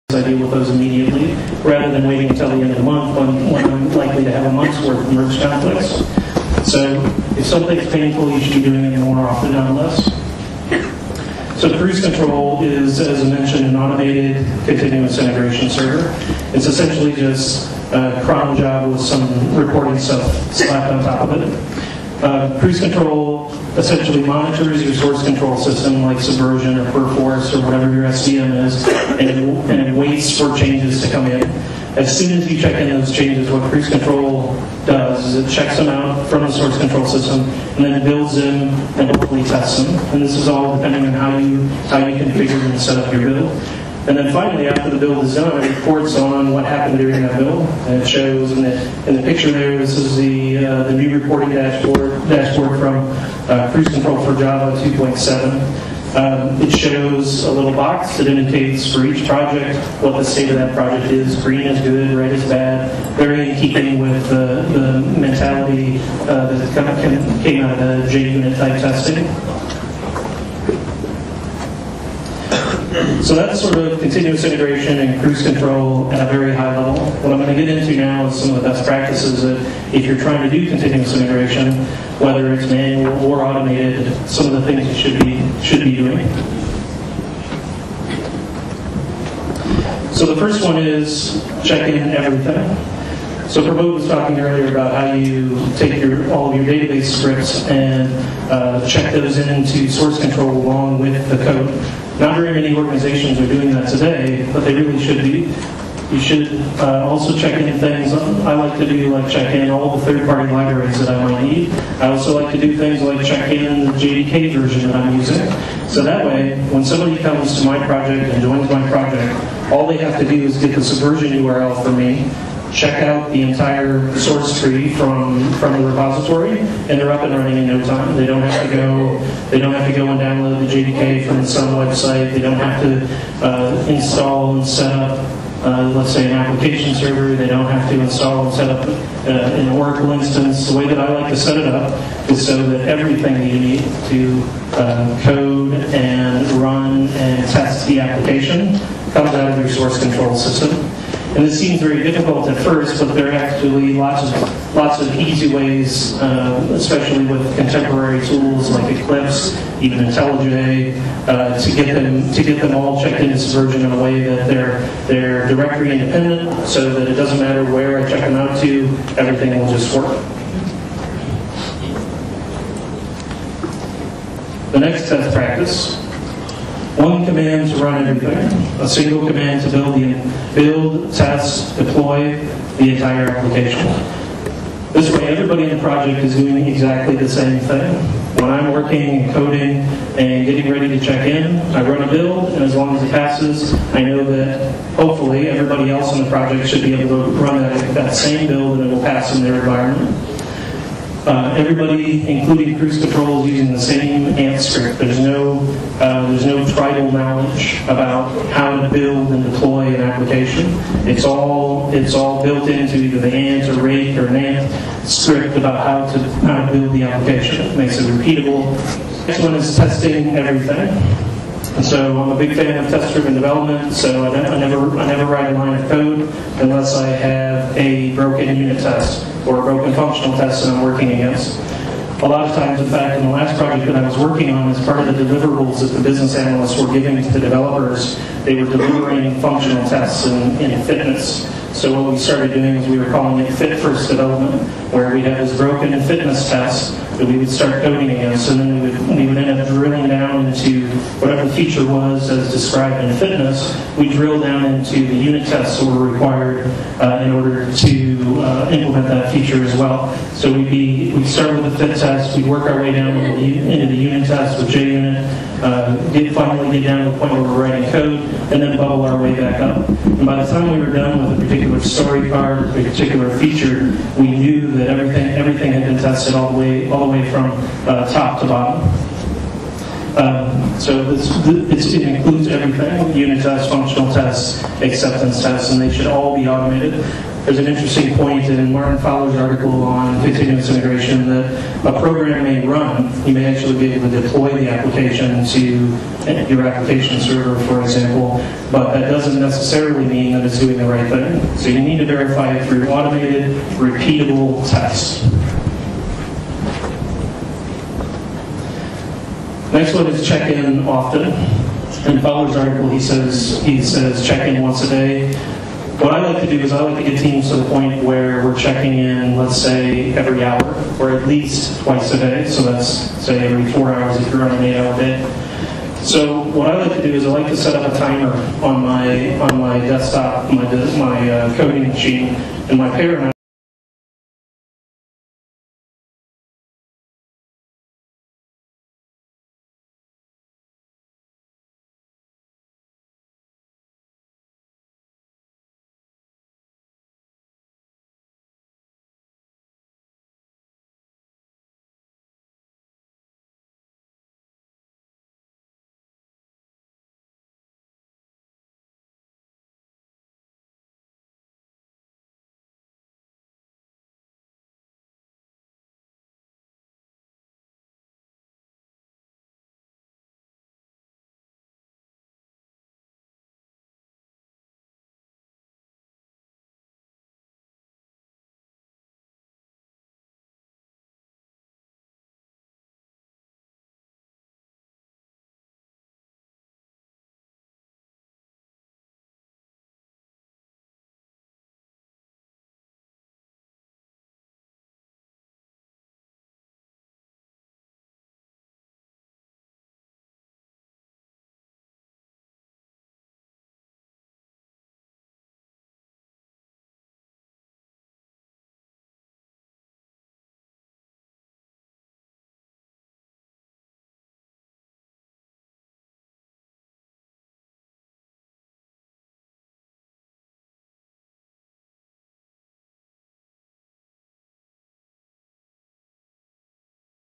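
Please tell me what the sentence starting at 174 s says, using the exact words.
The next test practice one command to run everything.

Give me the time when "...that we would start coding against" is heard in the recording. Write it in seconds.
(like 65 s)
247 s.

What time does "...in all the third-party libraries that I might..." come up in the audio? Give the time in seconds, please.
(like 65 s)
109 s.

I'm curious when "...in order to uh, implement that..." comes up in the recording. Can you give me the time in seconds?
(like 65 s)
257 s.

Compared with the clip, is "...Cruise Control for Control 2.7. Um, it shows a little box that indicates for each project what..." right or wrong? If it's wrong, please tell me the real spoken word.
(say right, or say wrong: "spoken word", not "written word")
wrong: "Java", not "Control".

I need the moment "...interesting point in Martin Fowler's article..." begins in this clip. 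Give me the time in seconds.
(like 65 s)
287 s.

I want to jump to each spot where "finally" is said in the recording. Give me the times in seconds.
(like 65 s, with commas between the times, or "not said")
44 s, 266 s.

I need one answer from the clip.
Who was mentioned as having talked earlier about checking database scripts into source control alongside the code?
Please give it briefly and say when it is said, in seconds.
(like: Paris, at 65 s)
Pramod, at 93 s.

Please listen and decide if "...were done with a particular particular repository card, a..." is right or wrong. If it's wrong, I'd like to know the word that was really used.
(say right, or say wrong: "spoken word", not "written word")
wrong: "story", not "repository".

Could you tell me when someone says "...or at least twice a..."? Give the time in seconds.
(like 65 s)
320 s.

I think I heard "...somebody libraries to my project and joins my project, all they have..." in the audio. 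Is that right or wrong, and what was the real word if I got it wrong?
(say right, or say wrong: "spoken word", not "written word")
wrong: "comes", not "libraries".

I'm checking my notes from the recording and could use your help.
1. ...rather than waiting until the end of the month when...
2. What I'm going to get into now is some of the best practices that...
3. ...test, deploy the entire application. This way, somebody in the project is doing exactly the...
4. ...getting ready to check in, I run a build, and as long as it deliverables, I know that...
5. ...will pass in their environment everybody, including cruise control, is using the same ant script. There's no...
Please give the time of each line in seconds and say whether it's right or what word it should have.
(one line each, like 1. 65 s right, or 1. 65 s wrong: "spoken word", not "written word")
1. 1 s right
2. 77 s right
3. 181 s wrong: "everybody", not "somebody"
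4. 190 s wrong: "passes", not "deliverables"
5. 198 s right.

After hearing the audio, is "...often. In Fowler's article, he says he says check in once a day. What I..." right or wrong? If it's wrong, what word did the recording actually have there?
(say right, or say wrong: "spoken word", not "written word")
right.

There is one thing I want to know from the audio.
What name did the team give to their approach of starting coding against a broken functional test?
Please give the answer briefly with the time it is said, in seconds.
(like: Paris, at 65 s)
Fit First Development, at 243 s.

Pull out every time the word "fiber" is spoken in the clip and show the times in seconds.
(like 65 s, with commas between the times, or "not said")
not said.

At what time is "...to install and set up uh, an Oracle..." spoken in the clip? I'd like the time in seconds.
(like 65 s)
137 s.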